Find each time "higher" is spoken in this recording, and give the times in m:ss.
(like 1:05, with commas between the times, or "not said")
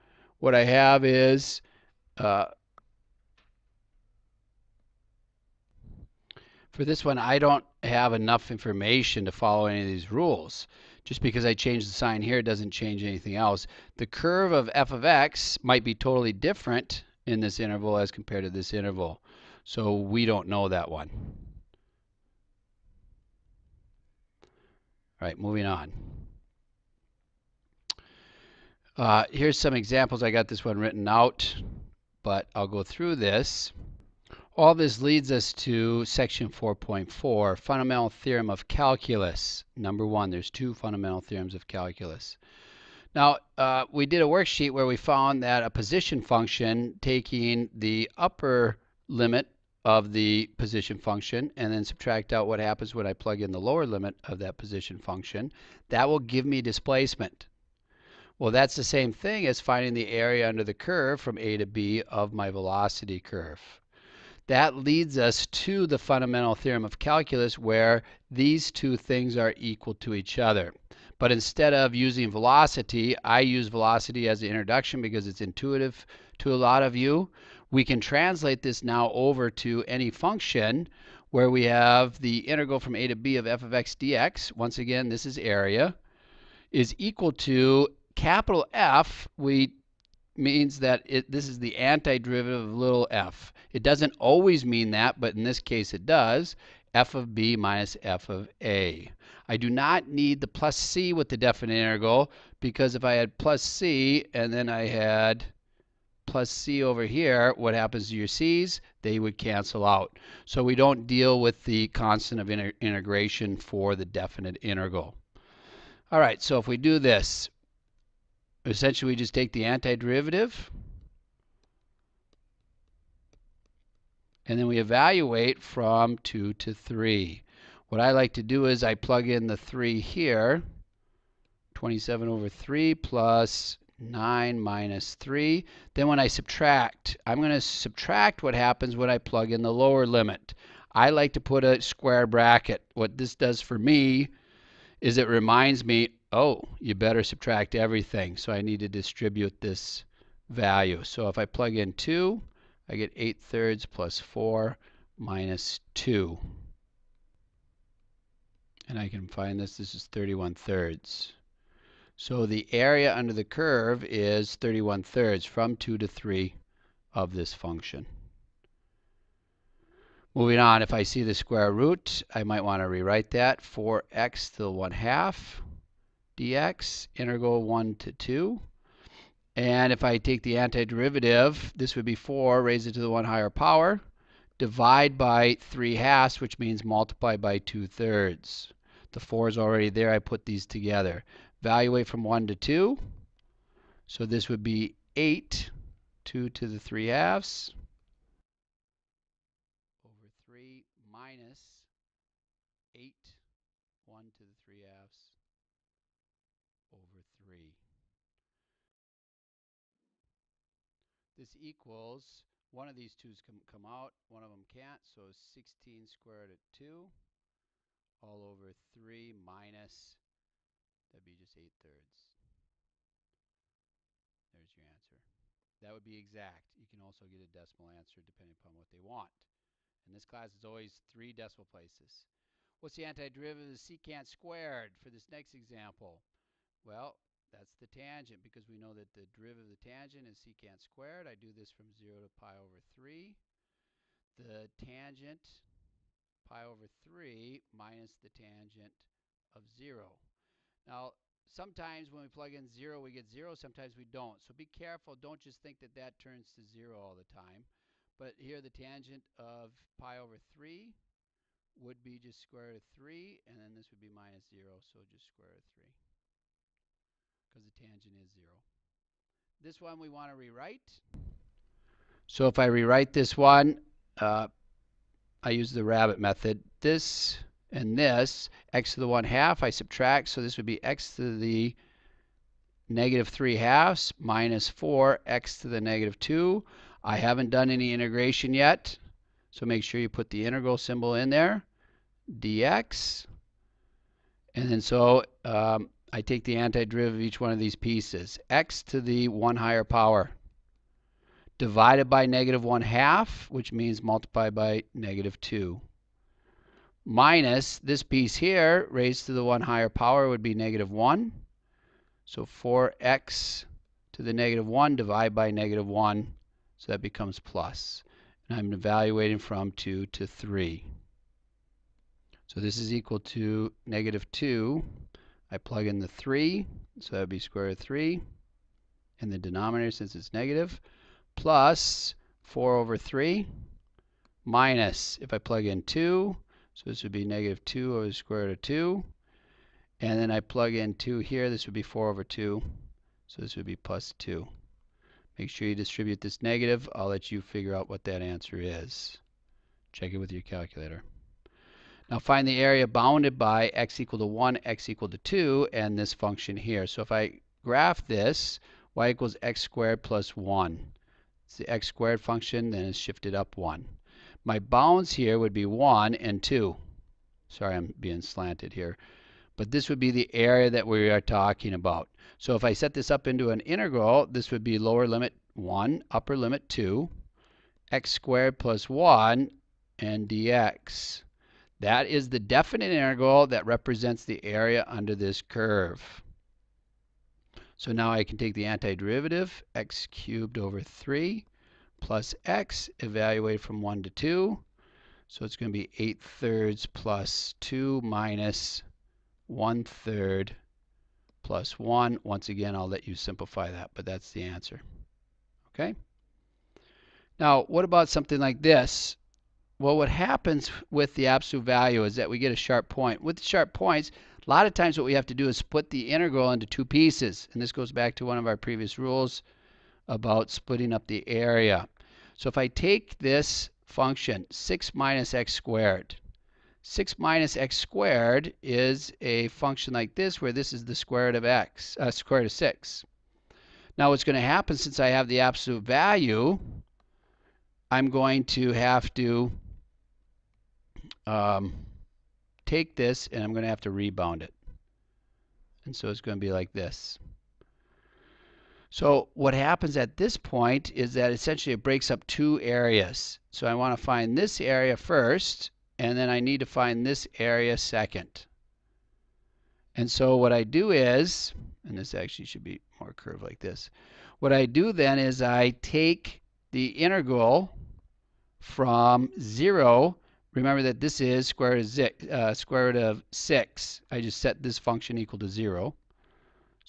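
3:03, 4:59, 5:09.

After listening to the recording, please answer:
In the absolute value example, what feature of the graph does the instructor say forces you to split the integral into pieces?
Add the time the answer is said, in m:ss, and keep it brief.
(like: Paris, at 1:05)
a sharp point, at 6:52.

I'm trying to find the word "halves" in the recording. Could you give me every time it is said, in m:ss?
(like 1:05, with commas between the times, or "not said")
3:05, 3:17, 3:24, 4:43.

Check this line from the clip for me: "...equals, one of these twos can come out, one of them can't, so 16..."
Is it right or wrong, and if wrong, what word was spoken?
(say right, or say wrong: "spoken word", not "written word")
right.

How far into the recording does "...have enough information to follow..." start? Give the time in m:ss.
0:07.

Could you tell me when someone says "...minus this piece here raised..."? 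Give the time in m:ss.
5:07.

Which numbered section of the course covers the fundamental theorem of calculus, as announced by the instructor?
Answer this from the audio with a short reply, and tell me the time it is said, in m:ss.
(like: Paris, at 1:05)
4.4, at 0:36.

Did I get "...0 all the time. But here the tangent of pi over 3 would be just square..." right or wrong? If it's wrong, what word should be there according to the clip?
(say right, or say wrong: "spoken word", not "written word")
right.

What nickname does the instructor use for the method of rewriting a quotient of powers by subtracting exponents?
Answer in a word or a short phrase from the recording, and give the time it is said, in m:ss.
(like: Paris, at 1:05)
the rabbit method, at 4:35.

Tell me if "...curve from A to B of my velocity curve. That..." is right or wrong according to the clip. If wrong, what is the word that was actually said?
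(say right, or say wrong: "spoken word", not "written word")
right.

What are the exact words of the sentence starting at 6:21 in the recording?
That is the definite integral that represents the area under this curve.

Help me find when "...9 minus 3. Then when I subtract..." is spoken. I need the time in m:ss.
2:13.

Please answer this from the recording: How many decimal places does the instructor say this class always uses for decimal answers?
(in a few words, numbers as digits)
3.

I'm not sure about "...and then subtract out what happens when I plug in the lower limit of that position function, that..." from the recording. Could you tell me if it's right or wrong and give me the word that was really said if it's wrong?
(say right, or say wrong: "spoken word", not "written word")
right.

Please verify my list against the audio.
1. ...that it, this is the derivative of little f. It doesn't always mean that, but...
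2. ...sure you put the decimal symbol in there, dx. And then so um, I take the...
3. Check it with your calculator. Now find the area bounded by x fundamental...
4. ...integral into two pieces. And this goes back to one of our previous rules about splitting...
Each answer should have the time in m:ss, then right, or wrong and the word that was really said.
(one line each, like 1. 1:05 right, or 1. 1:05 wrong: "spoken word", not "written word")
1. 1:30 wrong: "antiderivative", not "derivative"
2. 4:49 wrong: "integral", not "decimal"
3. 5:49 wrong: "equal", not "fundamental"
4. 6:56 right.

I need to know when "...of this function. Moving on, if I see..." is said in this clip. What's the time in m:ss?
2:47.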